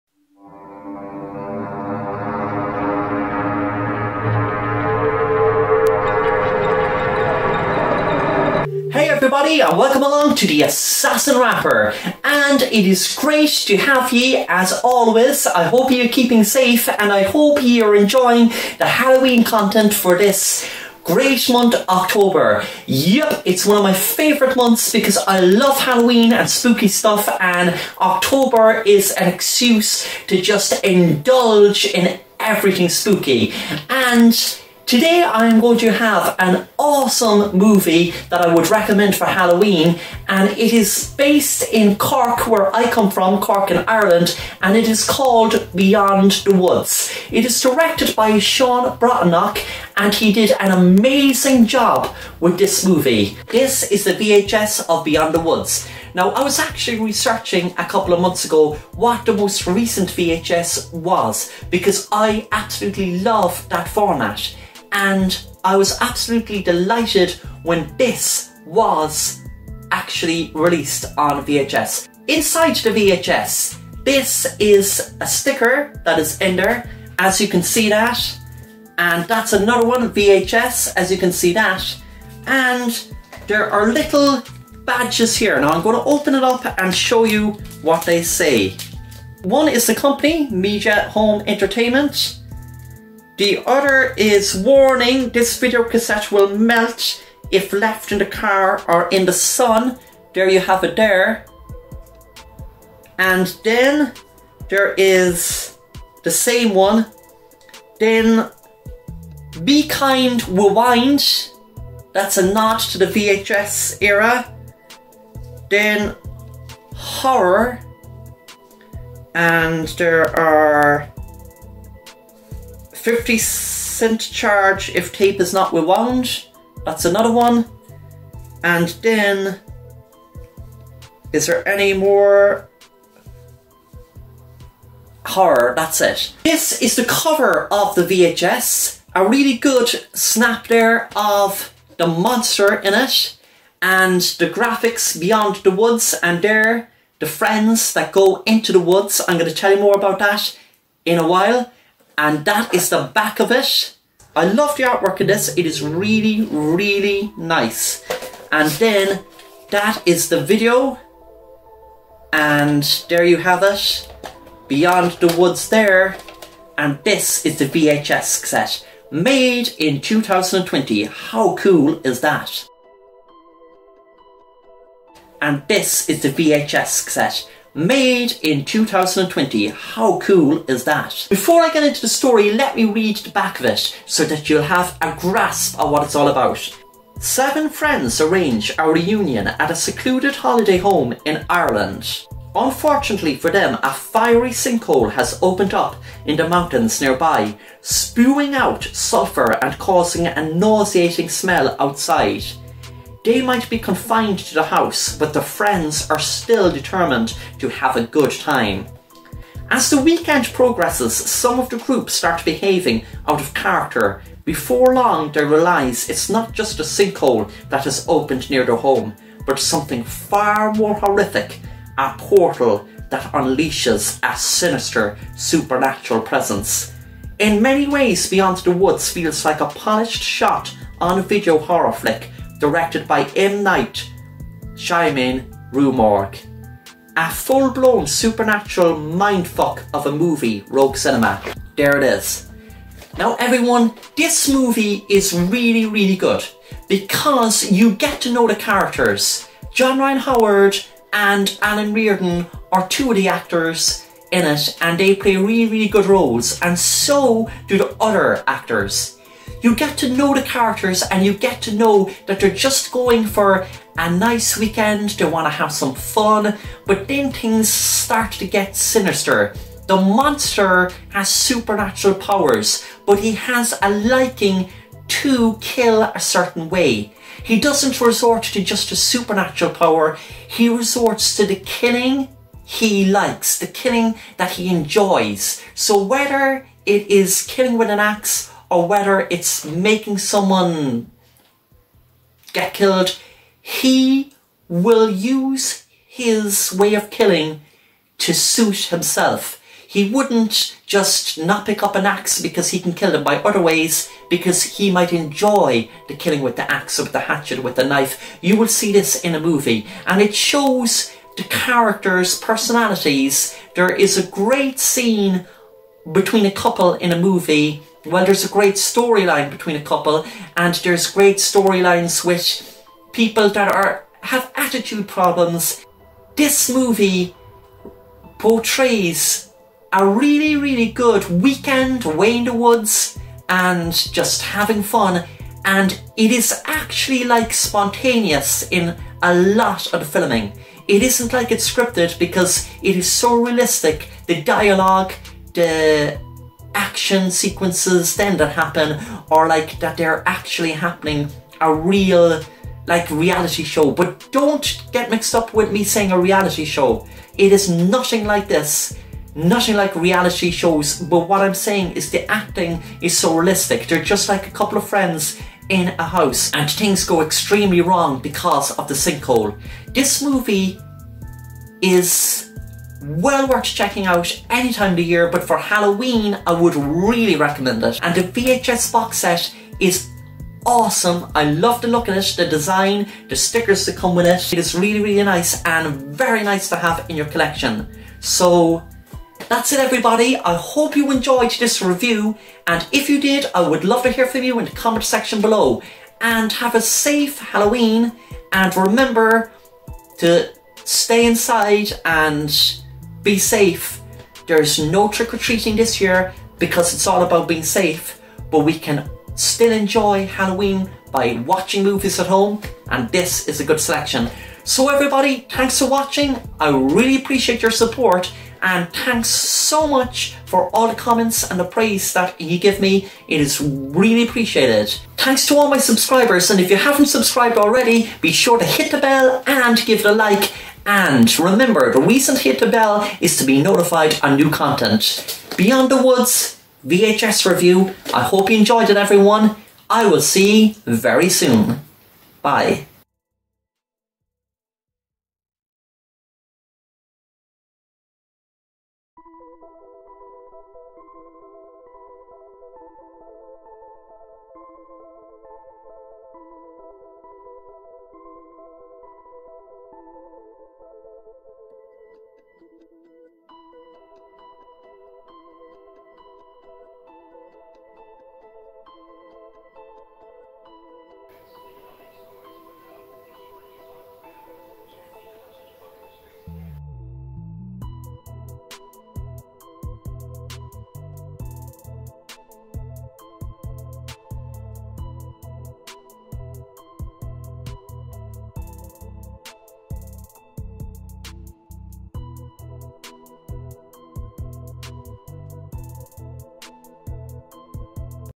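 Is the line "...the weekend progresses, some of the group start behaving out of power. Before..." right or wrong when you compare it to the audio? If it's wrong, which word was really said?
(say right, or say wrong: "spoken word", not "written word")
wrong: "character", not "power".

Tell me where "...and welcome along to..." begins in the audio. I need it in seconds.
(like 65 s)
9 s.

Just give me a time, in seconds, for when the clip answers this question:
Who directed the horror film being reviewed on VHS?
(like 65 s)
48 s.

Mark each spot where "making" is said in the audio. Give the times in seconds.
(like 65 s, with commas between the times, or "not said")
289 s.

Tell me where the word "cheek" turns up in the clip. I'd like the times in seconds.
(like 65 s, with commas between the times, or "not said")
not said.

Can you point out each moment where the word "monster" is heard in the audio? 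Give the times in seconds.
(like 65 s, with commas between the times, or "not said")
142 s, 269 s.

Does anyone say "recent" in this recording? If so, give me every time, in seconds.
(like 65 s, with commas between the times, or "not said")
59 s, 432 s.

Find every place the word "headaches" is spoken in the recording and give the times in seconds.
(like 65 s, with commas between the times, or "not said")
not said.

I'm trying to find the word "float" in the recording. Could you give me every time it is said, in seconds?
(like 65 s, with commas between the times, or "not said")
not said.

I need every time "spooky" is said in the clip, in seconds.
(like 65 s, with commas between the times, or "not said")
26 s, 32 s.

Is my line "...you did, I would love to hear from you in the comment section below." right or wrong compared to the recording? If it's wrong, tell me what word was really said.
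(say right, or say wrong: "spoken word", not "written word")
right.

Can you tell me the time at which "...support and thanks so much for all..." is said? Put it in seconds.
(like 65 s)
417 s.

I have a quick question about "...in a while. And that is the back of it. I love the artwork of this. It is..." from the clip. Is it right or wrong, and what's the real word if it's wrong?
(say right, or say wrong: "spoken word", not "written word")
right.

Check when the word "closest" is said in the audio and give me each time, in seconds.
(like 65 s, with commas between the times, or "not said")
not said.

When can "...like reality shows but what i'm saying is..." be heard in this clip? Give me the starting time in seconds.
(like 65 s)
359 s.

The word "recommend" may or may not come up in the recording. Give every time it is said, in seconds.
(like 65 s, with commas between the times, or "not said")
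38 s, 377 s.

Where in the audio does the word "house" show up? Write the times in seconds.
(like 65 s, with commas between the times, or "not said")
204 s, 366 s.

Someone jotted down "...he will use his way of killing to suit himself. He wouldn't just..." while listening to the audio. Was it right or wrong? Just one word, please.
right.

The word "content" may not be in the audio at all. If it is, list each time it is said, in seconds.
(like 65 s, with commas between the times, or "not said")
19 s, 434 s.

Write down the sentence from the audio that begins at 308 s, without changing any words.
You will see this in a movie, and it shows the characters' personalities.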